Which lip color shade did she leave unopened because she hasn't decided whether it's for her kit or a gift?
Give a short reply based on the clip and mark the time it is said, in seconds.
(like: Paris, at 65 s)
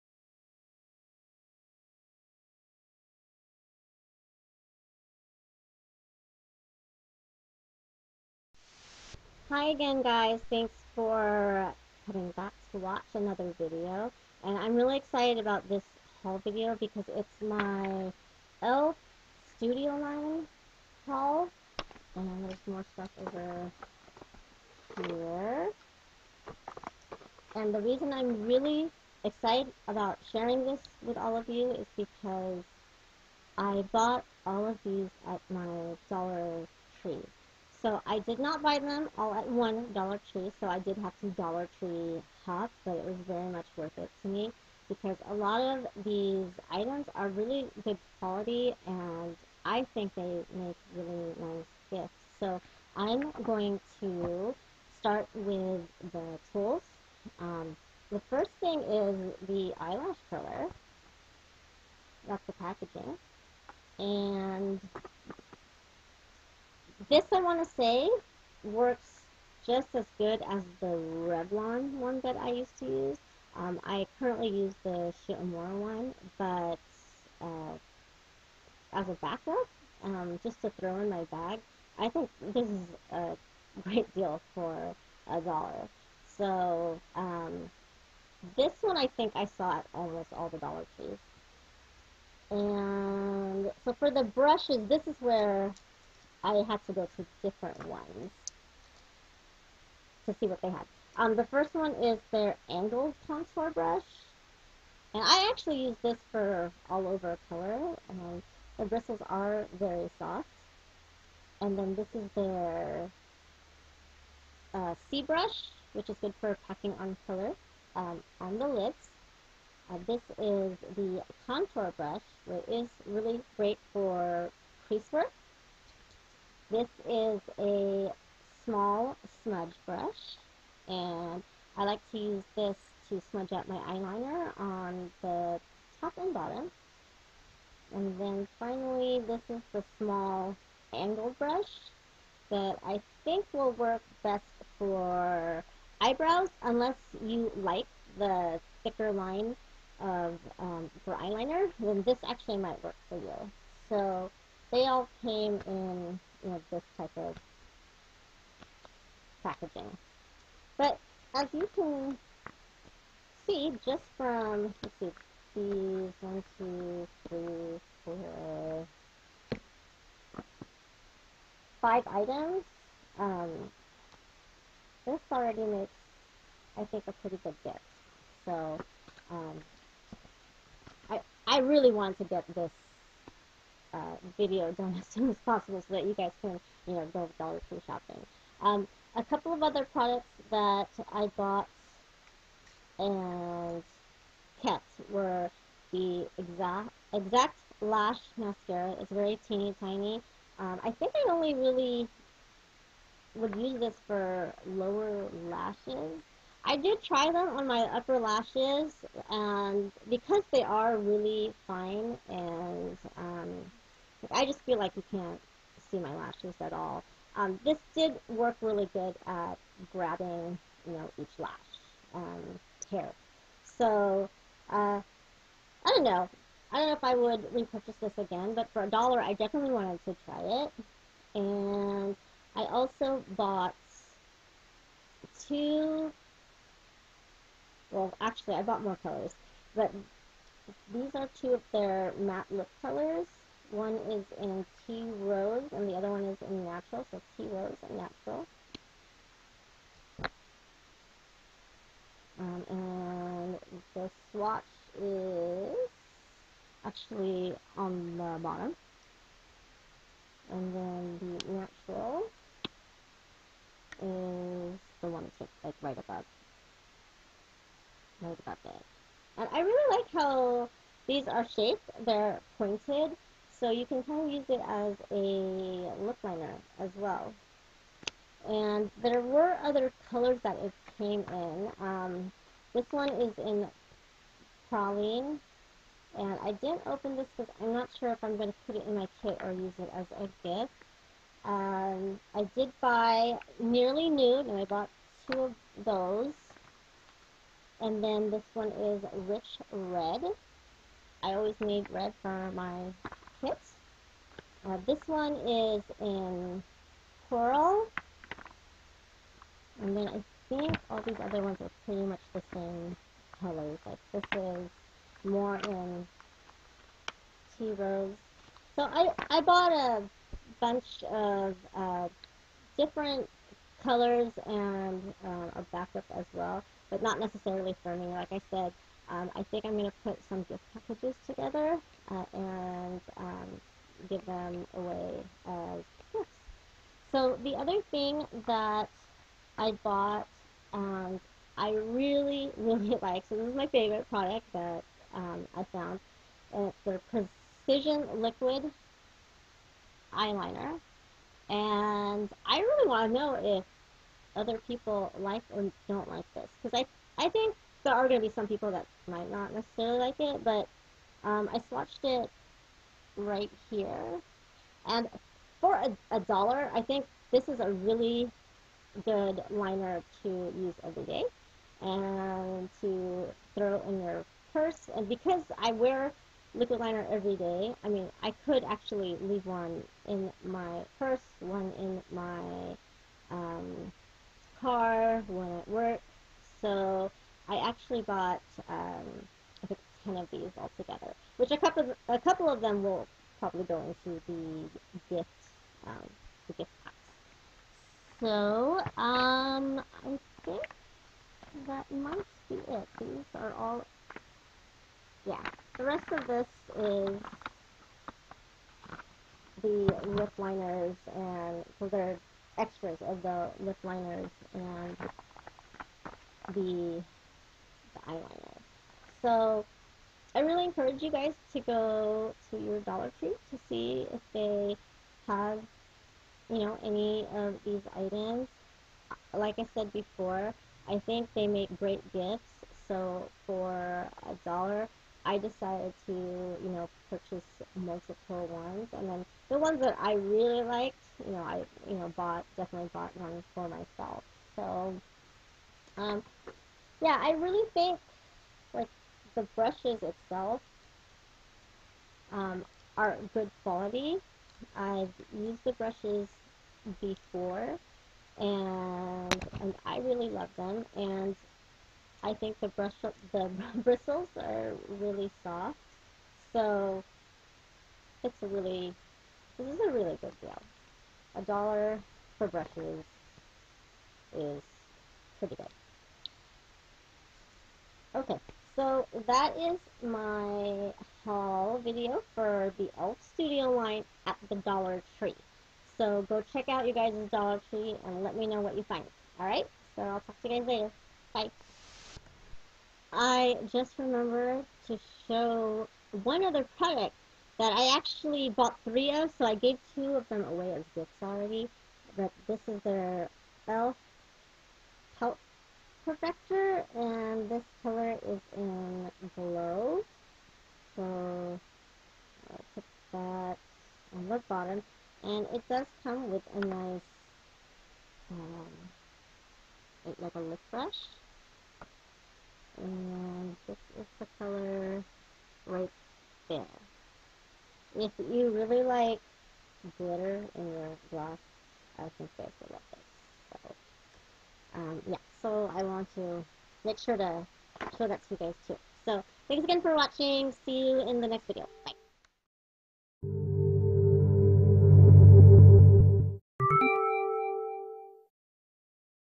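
Praline, at 284 s.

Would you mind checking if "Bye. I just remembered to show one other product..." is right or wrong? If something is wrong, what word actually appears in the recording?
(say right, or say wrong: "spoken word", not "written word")
right.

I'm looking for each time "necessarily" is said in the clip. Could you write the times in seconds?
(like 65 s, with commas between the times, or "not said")
327 s, 359 s.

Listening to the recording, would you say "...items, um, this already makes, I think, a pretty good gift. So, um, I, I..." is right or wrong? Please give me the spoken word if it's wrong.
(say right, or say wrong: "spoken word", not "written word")
right.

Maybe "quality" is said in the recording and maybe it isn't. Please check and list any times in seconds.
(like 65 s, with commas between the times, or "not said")
48 s, 453 s.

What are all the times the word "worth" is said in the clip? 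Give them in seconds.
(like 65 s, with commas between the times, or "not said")
43 s.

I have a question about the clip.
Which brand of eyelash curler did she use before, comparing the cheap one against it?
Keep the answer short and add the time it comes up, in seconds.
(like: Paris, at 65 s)
Revlon, at 70 s.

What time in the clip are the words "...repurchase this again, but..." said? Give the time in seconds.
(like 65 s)
227 s.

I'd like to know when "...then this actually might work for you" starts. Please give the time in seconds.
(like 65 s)
151 s.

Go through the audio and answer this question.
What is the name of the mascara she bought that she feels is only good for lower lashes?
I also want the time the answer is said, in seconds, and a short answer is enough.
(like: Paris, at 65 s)
Exact lash, at 197 s.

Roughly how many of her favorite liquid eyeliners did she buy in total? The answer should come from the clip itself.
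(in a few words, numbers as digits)
10.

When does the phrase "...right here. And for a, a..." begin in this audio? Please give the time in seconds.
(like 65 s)
363 s.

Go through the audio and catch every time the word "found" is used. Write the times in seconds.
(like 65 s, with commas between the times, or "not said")
345 s.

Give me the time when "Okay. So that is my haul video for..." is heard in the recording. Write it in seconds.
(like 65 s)
478 s.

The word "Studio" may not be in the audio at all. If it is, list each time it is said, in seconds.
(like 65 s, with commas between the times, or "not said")
19 s, 483 s.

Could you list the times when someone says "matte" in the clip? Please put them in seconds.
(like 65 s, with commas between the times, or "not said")
242 s.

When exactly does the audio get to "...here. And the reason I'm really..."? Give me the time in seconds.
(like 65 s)
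25 s.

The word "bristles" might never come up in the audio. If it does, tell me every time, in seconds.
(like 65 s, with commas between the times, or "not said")
108 s, 463 s.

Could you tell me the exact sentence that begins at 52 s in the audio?
So I'm going to start with the tools.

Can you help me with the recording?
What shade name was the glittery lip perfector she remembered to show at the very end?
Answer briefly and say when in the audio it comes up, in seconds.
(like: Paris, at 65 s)
Glow, at 509 s.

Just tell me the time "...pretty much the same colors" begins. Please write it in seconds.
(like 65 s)
311 s.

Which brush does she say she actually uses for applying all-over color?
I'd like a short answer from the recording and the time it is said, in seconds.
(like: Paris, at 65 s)
Angled contour brush, at 102 s.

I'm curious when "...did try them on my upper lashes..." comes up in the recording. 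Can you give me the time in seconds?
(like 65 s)
206 s.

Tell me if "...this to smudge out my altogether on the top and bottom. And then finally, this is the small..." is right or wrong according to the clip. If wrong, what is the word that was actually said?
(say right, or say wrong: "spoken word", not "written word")
wrong: "eyeliner", not "altogether".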